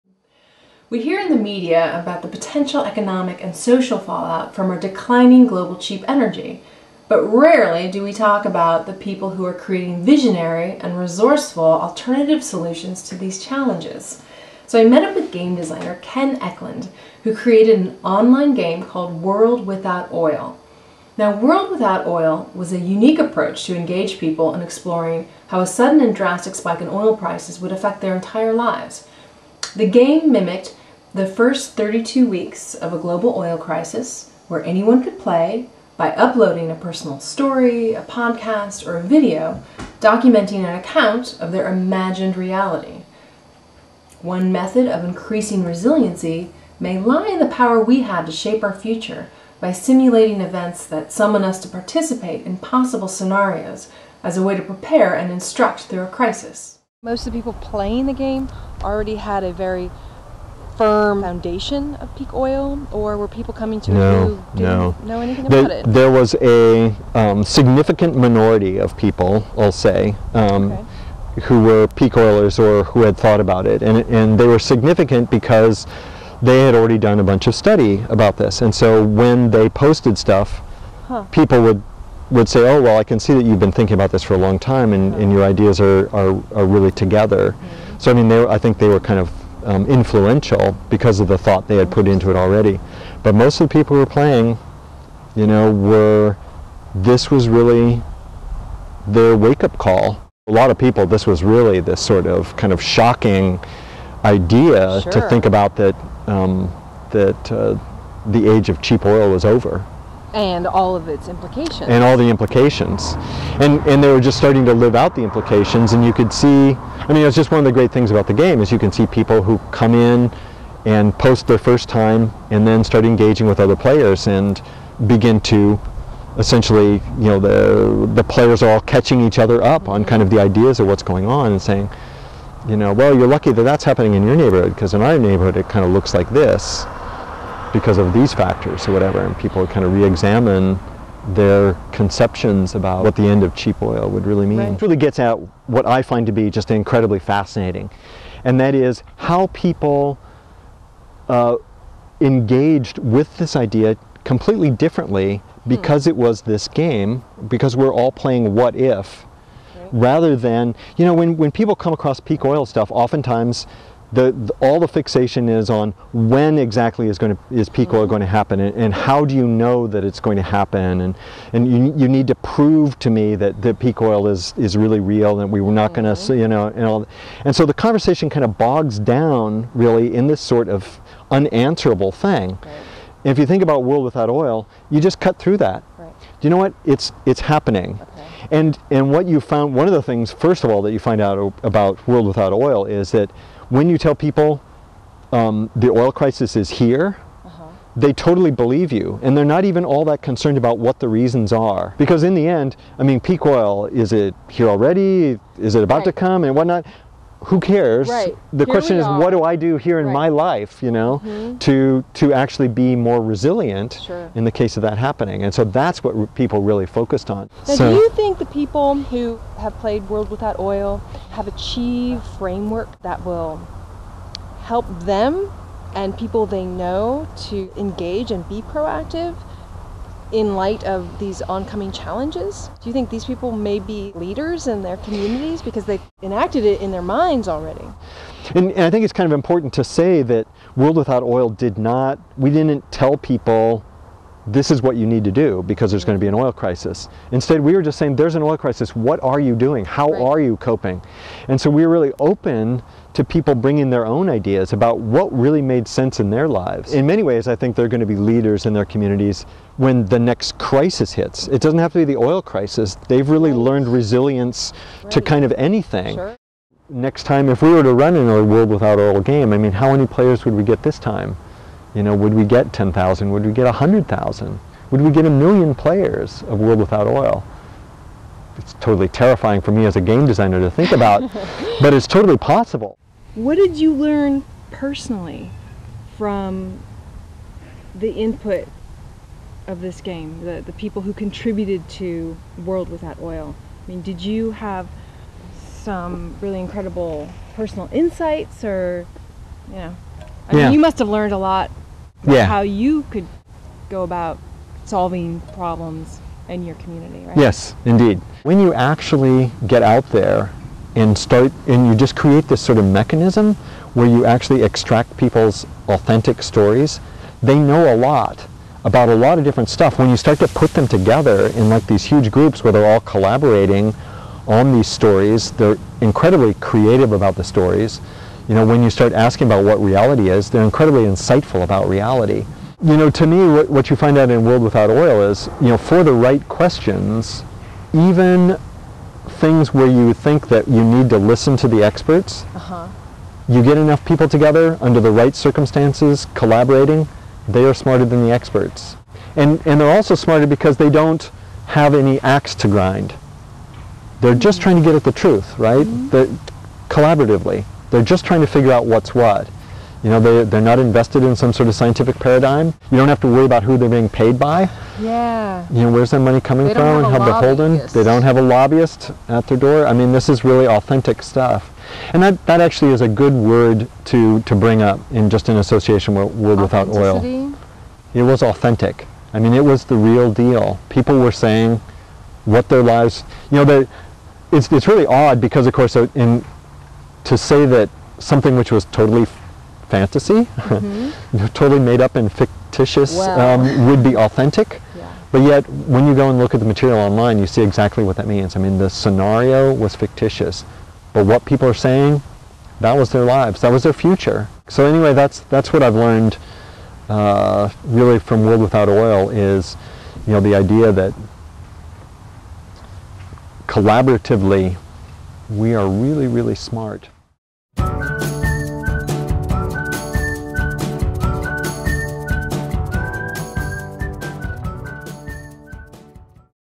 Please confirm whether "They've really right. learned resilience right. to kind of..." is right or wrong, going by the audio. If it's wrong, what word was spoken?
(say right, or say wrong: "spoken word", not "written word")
right.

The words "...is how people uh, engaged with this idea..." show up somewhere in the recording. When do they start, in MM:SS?
02:28.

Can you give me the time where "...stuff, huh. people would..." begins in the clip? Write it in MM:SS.
01:20.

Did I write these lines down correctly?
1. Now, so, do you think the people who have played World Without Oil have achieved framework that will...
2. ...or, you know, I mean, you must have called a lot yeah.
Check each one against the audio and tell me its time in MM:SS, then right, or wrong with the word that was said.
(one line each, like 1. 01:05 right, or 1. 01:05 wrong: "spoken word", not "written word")
1. 03:37 right
2. 04:58 wrong: "learned", not "called".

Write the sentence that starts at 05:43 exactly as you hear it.
you get enough people together under the right circumstances, collaborating, they are smarter than the experts.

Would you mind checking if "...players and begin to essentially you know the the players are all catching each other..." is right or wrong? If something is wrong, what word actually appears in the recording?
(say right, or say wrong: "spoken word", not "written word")
right.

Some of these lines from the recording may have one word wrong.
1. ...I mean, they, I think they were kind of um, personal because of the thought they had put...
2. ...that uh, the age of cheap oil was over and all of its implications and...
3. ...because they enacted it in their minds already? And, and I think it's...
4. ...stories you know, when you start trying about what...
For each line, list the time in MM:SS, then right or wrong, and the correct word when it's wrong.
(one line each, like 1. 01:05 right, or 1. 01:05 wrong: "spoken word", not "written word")
1. 01:28 wrong: "influential", not "personal"
2. 01:47 right
3. 03:55 right
4. 05:27 wrong: "asking", not "trying".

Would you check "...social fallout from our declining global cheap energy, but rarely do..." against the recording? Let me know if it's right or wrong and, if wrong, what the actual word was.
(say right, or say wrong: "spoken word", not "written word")
right.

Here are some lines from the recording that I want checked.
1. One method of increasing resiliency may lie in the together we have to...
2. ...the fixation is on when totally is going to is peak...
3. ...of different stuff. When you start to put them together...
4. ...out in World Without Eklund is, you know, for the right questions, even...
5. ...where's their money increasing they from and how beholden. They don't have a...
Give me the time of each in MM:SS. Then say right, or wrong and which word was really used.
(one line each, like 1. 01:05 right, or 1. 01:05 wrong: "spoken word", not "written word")
1. 00:44 wrong: "power", not "together"
2. 02:44 wrong: "exactly", not "totally"
3. 05:19 right
4. 05:34 wrong: "Oil", not "Eklund"
5. 06:05 wrong: "coming", not "increasing".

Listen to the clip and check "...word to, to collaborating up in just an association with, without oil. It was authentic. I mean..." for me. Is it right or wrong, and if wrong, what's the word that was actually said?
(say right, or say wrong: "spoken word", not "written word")
wrong: "bring", not "collaborating".